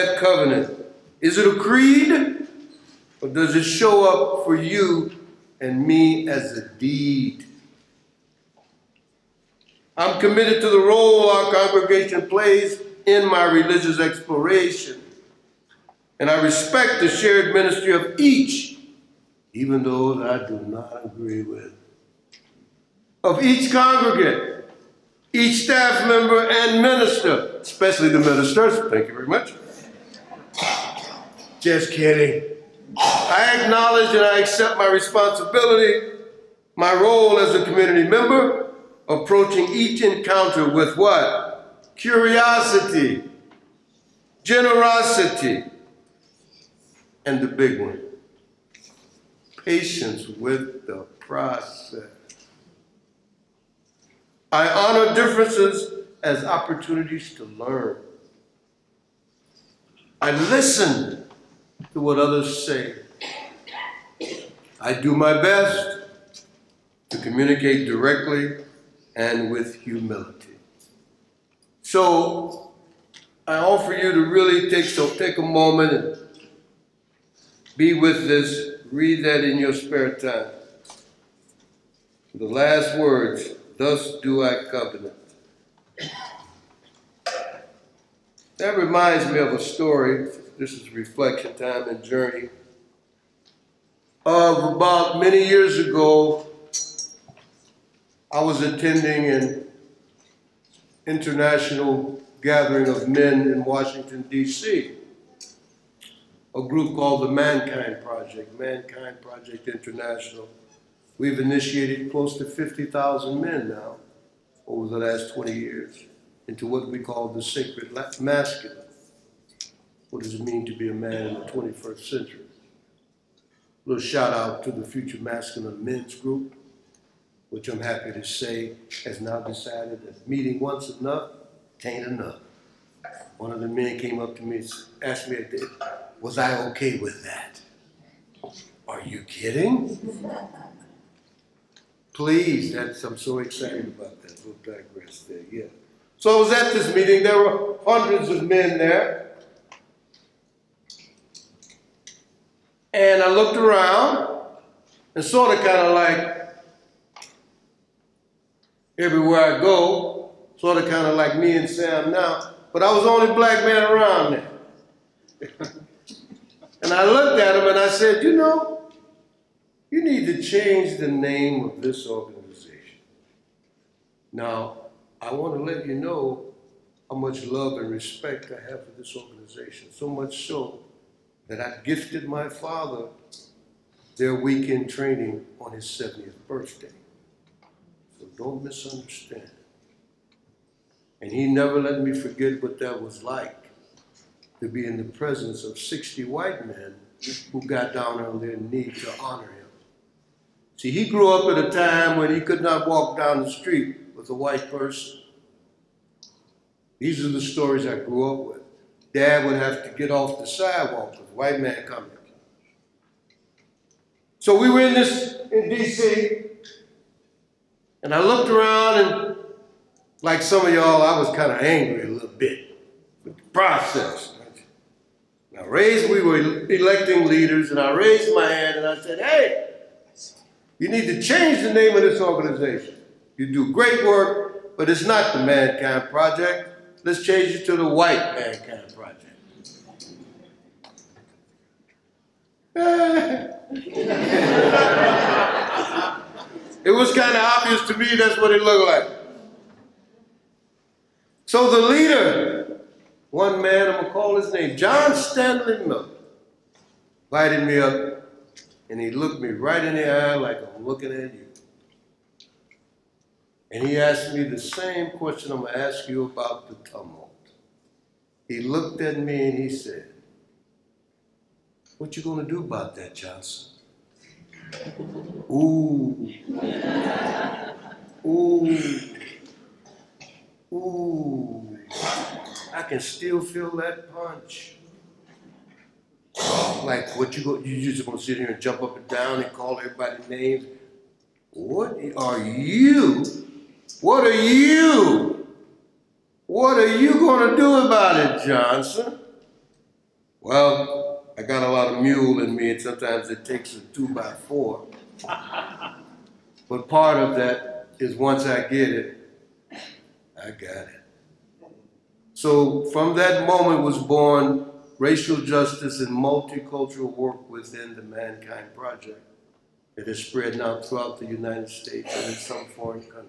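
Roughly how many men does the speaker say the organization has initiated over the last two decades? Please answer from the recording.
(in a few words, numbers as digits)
50,000.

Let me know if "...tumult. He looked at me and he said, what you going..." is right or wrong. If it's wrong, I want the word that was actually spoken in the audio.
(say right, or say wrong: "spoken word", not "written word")
right.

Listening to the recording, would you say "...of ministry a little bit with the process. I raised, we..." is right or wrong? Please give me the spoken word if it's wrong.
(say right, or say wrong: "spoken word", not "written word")
wrong: "angry", not "ministry".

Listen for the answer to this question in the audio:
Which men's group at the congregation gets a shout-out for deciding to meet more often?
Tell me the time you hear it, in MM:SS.
02:04.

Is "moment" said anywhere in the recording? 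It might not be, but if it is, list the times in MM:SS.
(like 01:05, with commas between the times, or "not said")
01:15, 05:13.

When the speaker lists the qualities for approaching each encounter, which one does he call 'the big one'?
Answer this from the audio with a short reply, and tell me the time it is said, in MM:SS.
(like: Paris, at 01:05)
Patience, at 00:49.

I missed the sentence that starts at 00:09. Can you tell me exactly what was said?
I'm committed to the role our congregation plays in my religious exploration.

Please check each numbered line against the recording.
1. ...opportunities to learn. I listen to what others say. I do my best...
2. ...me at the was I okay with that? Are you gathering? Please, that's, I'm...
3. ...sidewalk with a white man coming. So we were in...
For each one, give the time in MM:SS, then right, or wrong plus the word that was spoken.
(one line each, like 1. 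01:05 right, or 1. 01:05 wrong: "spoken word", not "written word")
1. 00:56 right
2. 02:15 wrong: "kidding", not "gathering"
3. 03:30 right.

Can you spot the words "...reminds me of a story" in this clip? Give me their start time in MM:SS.
01:28.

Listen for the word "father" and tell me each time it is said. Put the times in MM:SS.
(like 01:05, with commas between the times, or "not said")
03:02.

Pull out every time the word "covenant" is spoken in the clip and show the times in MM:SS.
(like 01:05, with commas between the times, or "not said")
00:00, 01:24.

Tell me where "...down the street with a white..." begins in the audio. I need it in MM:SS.
03:23.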